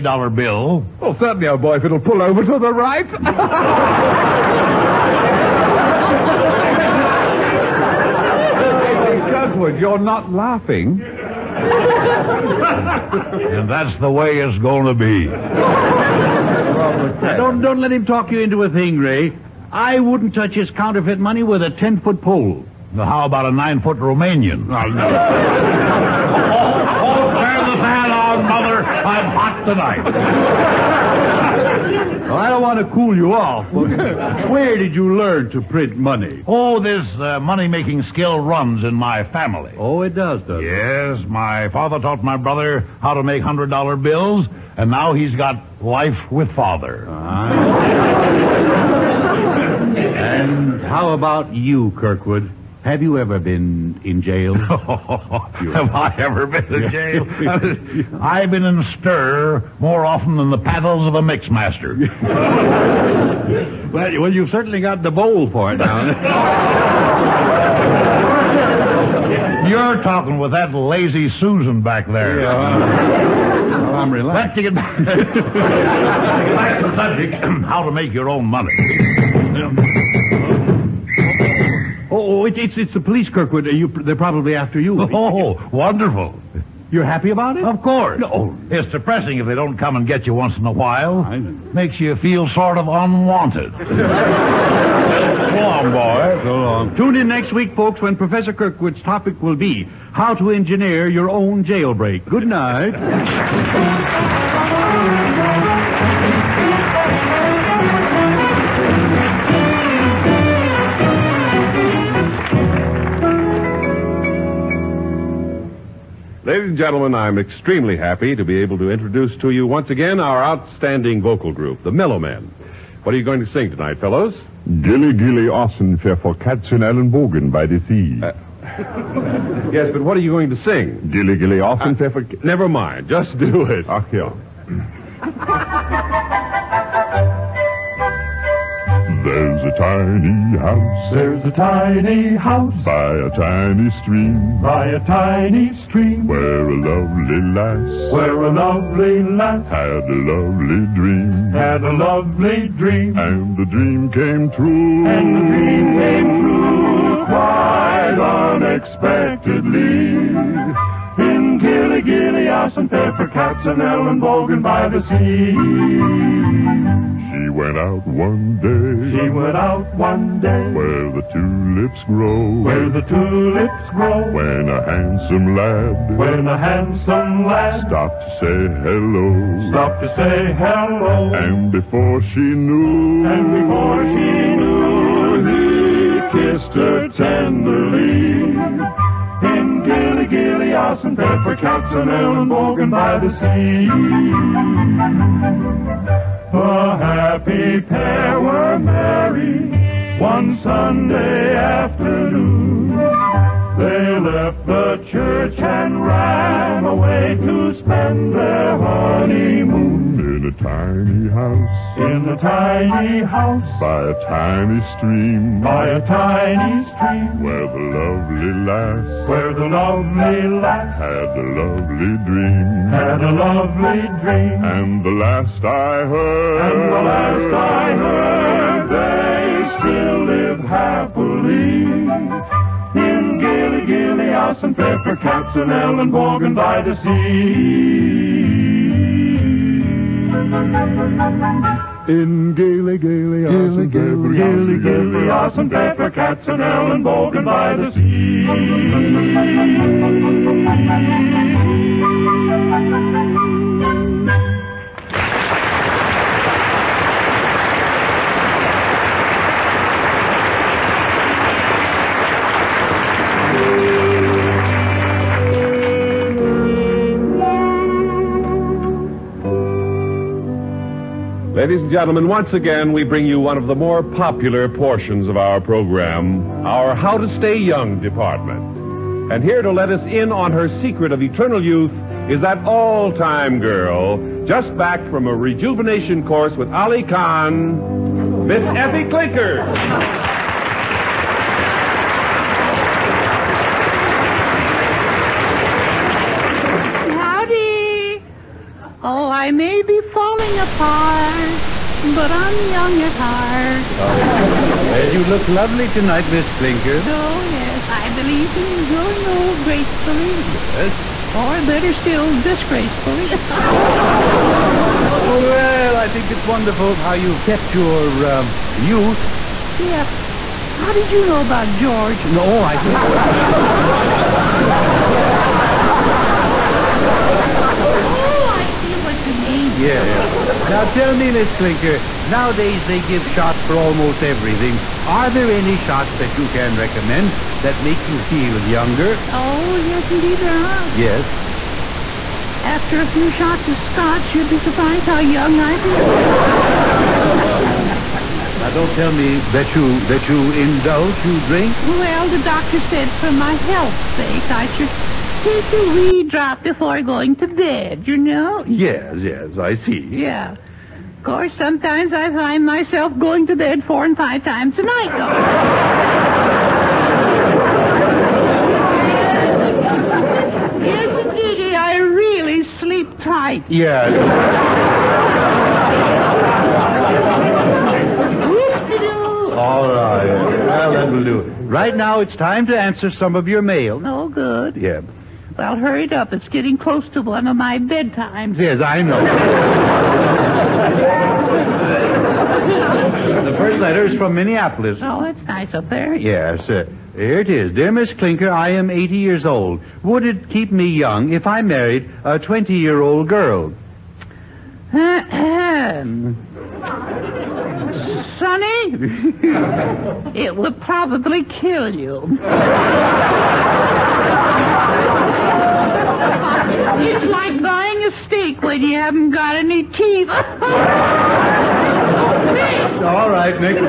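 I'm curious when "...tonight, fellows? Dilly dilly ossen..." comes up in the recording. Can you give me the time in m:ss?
2:03.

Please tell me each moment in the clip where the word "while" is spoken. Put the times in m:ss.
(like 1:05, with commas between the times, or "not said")
1:30.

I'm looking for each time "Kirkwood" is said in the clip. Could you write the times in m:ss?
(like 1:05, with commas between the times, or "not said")
0:09, 0:51, 1:23, 1:38.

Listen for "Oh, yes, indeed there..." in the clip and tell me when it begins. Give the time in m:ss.
5:39.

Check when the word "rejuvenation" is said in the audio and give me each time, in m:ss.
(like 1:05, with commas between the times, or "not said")
4:45.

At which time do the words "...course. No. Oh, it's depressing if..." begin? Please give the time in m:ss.
1:27.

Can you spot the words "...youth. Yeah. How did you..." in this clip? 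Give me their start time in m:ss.
5:18.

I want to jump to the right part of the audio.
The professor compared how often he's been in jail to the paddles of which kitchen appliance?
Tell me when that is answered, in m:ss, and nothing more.
1:01.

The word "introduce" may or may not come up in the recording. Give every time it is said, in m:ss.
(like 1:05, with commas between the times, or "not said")
1:58.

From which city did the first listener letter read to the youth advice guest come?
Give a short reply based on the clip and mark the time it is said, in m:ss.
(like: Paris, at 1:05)
Minneapolis, at 6:34.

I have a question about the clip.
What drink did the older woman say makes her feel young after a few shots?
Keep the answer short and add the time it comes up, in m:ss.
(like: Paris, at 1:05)
scotch, at 5:43.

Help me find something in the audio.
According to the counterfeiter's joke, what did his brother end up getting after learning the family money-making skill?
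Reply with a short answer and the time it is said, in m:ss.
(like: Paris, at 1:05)
life with father, at 0:45.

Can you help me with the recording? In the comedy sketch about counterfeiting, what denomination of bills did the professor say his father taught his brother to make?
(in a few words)
$100.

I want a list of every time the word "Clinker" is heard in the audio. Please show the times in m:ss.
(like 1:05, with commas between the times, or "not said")
4:49, 5:06, 5:31, 6:38.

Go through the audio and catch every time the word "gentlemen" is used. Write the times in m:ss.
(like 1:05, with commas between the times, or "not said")
1:56, 4:31.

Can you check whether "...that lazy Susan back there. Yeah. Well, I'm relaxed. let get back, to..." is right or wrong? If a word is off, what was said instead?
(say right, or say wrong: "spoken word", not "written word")
right.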